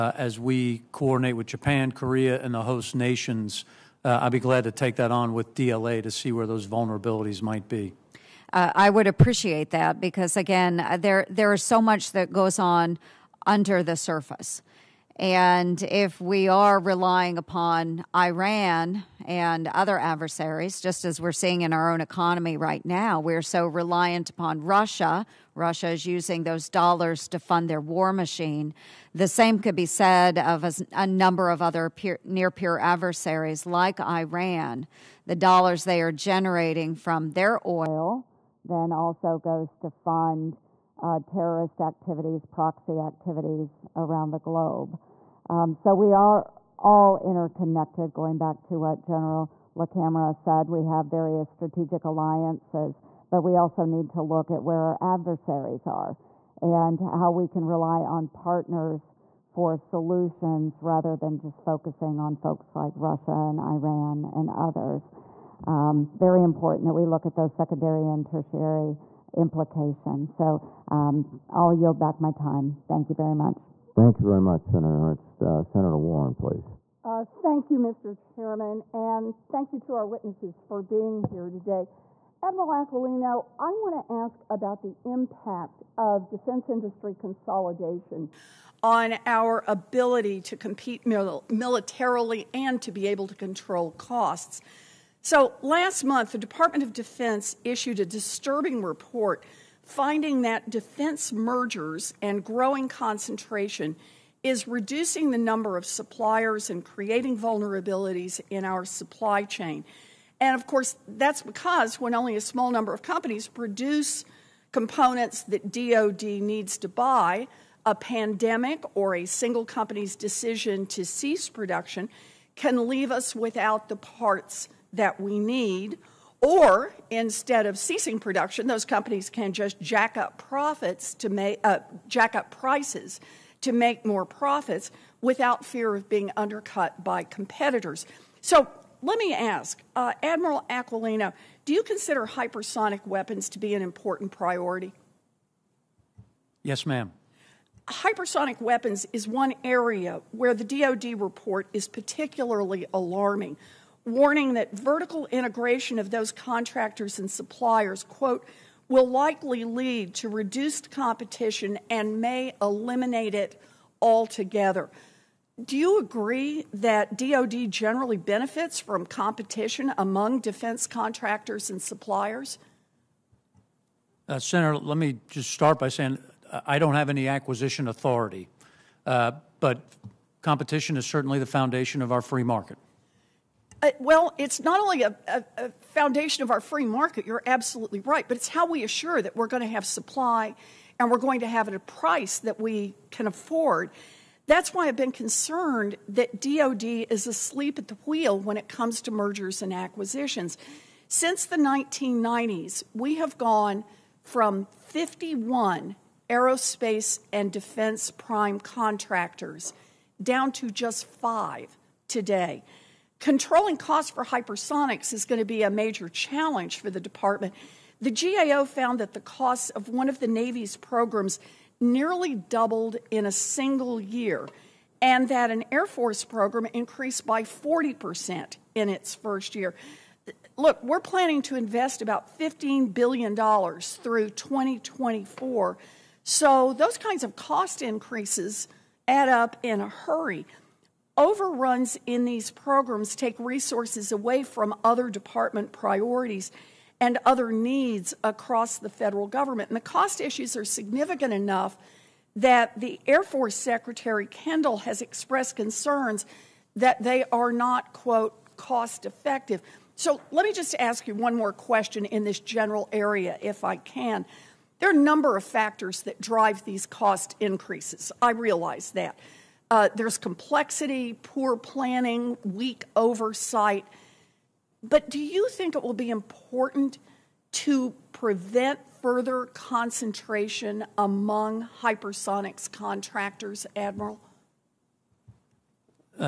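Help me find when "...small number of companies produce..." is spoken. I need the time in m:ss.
1:52.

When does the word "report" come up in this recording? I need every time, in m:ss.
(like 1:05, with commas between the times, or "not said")
1:38, 2:31.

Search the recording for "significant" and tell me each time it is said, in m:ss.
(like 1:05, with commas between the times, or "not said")
4:10.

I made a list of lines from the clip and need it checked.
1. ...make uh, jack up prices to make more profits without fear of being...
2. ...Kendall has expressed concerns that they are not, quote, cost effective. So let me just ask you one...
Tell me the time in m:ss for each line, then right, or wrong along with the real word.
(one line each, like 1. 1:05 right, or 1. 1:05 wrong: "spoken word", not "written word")
1. 2:11 right
2. 4:14 right.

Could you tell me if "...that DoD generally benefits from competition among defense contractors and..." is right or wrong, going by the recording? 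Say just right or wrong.
right.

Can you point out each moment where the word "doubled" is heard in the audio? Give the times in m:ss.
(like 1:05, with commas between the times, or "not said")
3:42.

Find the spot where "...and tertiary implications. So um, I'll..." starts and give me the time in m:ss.
1:08.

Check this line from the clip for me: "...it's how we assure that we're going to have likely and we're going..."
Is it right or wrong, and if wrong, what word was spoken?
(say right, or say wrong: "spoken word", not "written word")
wrong: "supply", not "likely".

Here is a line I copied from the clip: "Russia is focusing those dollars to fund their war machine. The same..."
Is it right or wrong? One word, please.
wrong.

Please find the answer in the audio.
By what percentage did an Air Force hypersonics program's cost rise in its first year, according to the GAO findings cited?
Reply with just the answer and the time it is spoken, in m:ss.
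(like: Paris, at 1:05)
40%, at 3:47.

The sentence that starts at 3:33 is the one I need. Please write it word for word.
Controlling costs for hypersonics is going to be a major challenge for the department.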